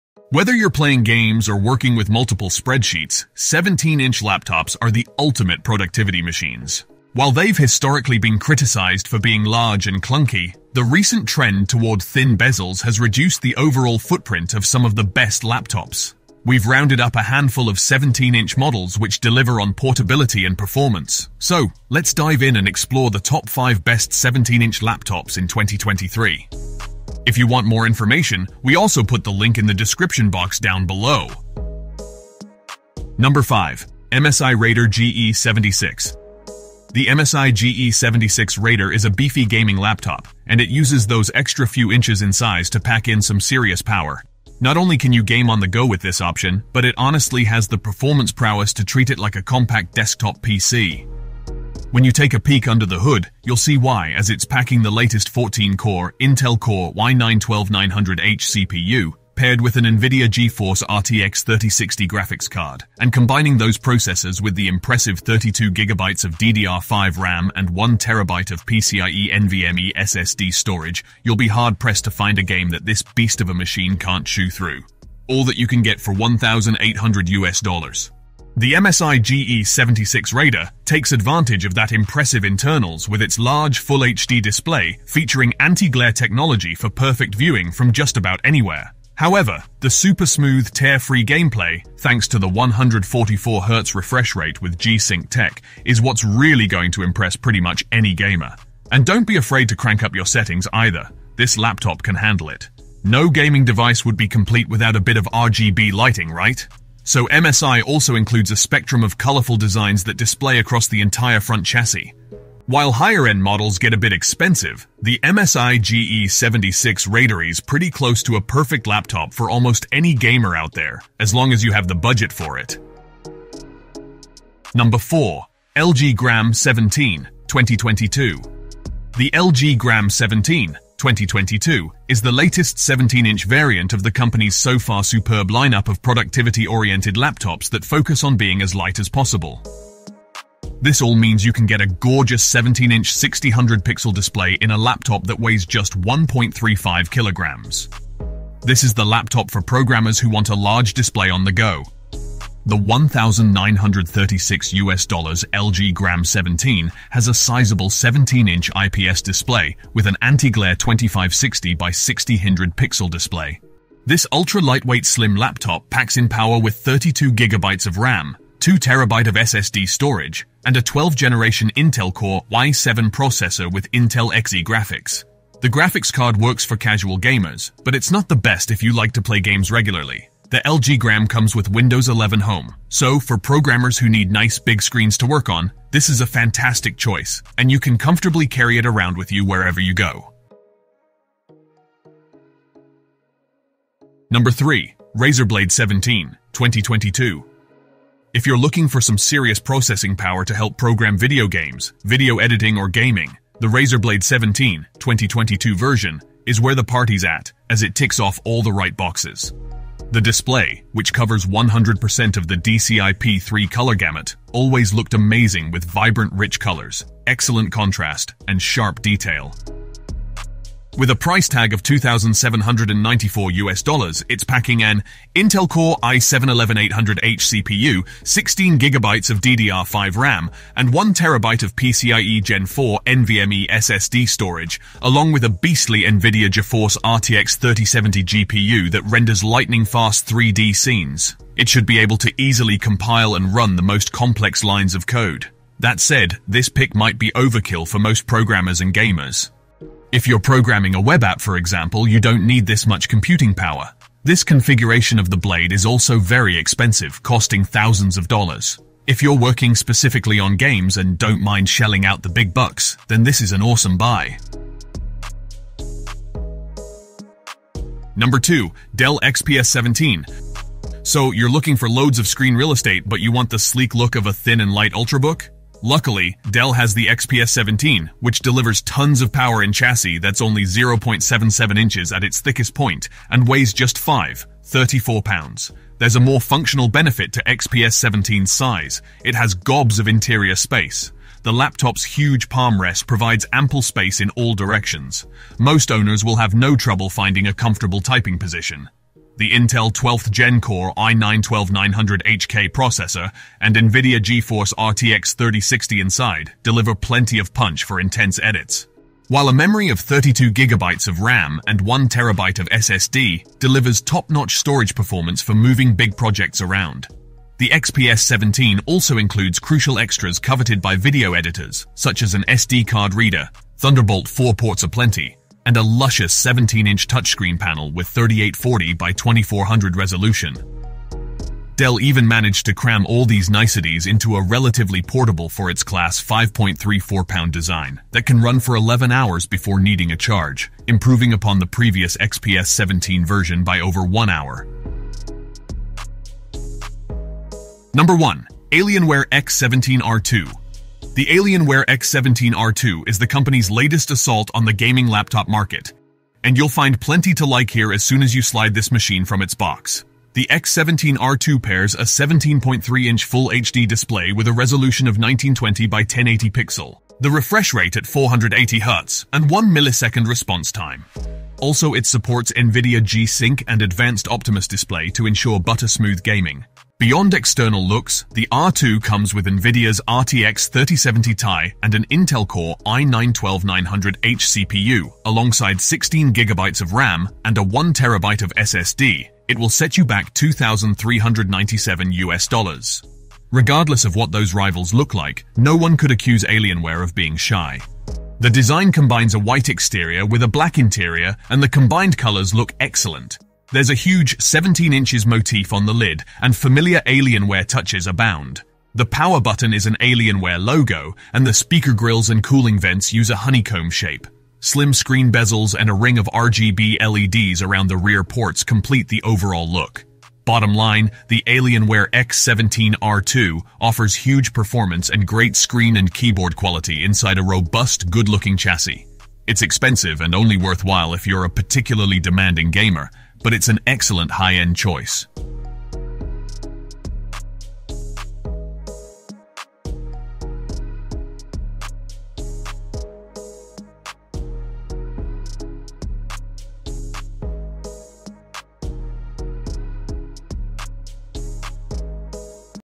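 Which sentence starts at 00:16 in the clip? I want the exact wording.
We've rounded up a handful of 17-inch models which deliver on portability and performance.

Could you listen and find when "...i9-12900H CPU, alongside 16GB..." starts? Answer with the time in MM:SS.
06:22.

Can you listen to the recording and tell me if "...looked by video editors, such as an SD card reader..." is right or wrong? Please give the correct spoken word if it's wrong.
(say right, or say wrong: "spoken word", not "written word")
wrong: "coveted", not "looked".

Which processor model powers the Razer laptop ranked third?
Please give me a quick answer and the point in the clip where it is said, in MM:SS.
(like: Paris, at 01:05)
Intel Core i7-11800H, at 03:45.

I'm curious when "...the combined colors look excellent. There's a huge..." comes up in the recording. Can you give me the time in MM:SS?
06:41.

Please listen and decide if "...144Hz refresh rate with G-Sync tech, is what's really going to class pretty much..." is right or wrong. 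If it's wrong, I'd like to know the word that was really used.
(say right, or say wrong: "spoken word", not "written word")
wrong: "impress", not "class".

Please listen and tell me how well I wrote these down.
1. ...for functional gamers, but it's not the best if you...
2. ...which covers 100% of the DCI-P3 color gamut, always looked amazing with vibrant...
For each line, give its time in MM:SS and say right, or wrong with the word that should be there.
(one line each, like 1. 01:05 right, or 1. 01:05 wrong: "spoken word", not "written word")
1. 02:56 wrong: "casual", not "functional"
2. 03:30 right.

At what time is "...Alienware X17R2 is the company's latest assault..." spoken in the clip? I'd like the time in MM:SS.
05:51.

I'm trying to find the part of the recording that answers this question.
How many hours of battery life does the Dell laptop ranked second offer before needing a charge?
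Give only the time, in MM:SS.
05:38.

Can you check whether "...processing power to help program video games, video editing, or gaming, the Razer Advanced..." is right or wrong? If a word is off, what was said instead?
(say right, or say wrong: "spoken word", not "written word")
wrong: "Blade", not "Advanced".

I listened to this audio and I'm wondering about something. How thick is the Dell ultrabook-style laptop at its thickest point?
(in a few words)
0.77 inches.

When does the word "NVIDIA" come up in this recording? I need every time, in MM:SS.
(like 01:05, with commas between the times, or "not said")
00:59, 03:56, 05:03, 06:12, 06:19.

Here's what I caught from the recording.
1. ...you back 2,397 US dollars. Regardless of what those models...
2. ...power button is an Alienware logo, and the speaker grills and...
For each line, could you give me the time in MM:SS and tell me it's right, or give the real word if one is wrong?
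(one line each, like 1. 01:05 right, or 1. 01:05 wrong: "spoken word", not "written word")
1. 06:29 wrong: "rivals", not "models"
2. 06:49 right.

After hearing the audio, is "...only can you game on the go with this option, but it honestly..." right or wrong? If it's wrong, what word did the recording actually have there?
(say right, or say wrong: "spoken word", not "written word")
right.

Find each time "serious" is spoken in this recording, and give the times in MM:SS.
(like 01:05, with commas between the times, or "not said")
00:43, 03:19.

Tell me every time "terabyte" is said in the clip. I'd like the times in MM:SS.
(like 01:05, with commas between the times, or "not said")
02:48, 03:51.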